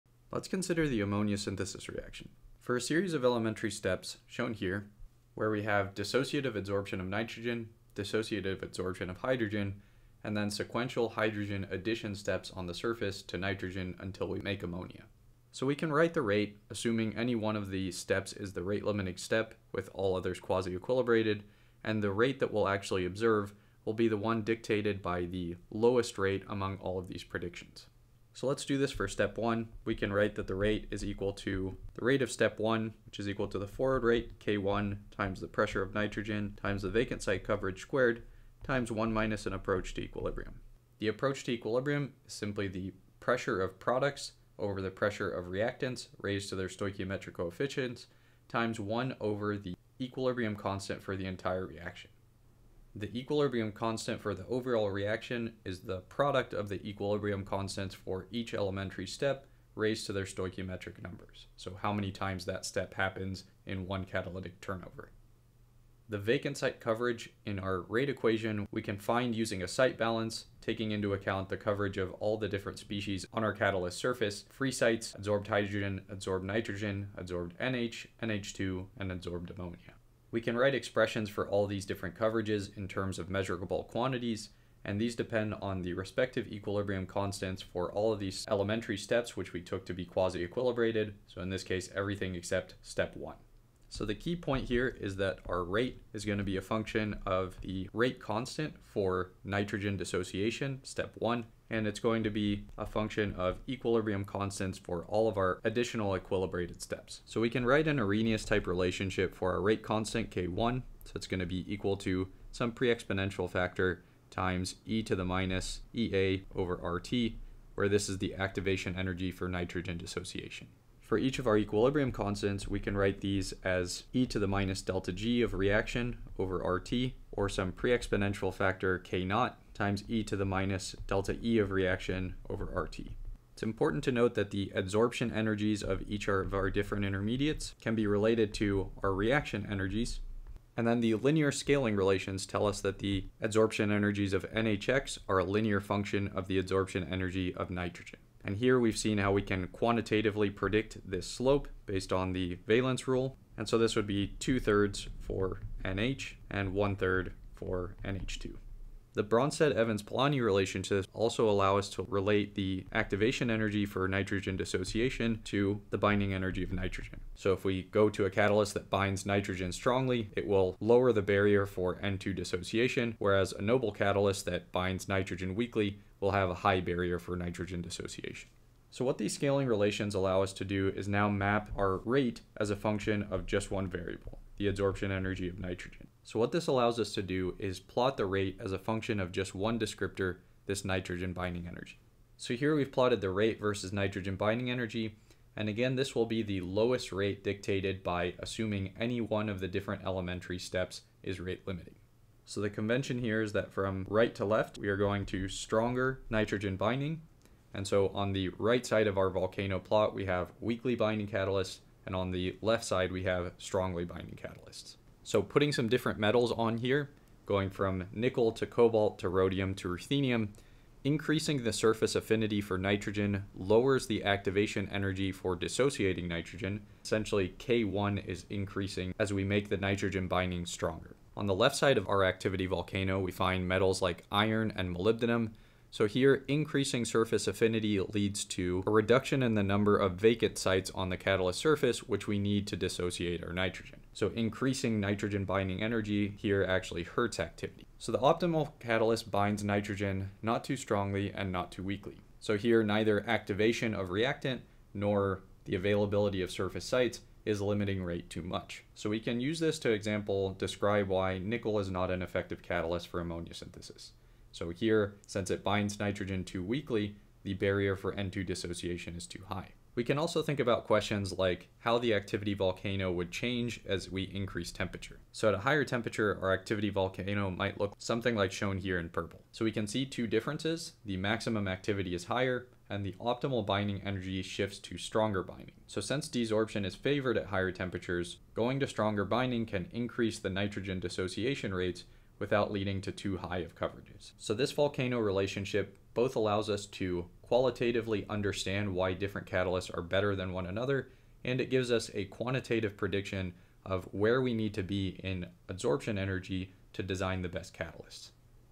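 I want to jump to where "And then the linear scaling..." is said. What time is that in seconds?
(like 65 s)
140 s.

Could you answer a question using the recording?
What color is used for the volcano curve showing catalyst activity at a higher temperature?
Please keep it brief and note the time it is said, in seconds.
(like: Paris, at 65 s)
Purple, at 279 s.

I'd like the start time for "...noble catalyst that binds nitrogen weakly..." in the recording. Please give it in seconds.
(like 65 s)
173 s.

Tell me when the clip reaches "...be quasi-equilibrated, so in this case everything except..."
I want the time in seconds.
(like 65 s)
89 s.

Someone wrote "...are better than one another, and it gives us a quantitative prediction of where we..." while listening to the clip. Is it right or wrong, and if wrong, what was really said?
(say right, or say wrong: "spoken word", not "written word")
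right.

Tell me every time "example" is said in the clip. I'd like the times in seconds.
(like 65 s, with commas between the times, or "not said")
259 s.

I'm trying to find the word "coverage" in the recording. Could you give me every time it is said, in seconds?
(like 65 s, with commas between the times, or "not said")
37 s, 66 s, 71 s, 82 s, 293 s.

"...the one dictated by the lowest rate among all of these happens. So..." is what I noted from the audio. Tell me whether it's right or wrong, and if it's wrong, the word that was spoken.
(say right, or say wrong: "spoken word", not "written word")
wrong: "predictions", not "happens".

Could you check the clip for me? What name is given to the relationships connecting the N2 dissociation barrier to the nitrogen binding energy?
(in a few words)
Bronsted-Evans-Polanyi relationships.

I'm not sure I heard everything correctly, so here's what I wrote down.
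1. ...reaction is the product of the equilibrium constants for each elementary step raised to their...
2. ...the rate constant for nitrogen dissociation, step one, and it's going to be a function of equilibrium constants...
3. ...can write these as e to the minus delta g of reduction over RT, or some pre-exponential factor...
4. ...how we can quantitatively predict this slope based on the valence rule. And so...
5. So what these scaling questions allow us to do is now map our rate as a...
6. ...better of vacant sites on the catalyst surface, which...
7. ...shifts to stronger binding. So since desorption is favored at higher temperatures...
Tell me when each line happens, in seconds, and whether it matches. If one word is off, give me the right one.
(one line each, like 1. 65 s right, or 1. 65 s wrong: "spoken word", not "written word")
1. 54 s right
2. 97 s right
3. 122 s wrong: "reaction", not "reduction"
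4. 149 s right
5. 178 s wrong: "relations", not "questions"
6. 239 s wrong: "number", not "better"
7. 284 s right.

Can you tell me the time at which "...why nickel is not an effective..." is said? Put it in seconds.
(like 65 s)
261 s.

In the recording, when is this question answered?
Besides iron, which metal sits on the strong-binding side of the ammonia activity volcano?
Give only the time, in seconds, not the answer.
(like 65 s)
234 s.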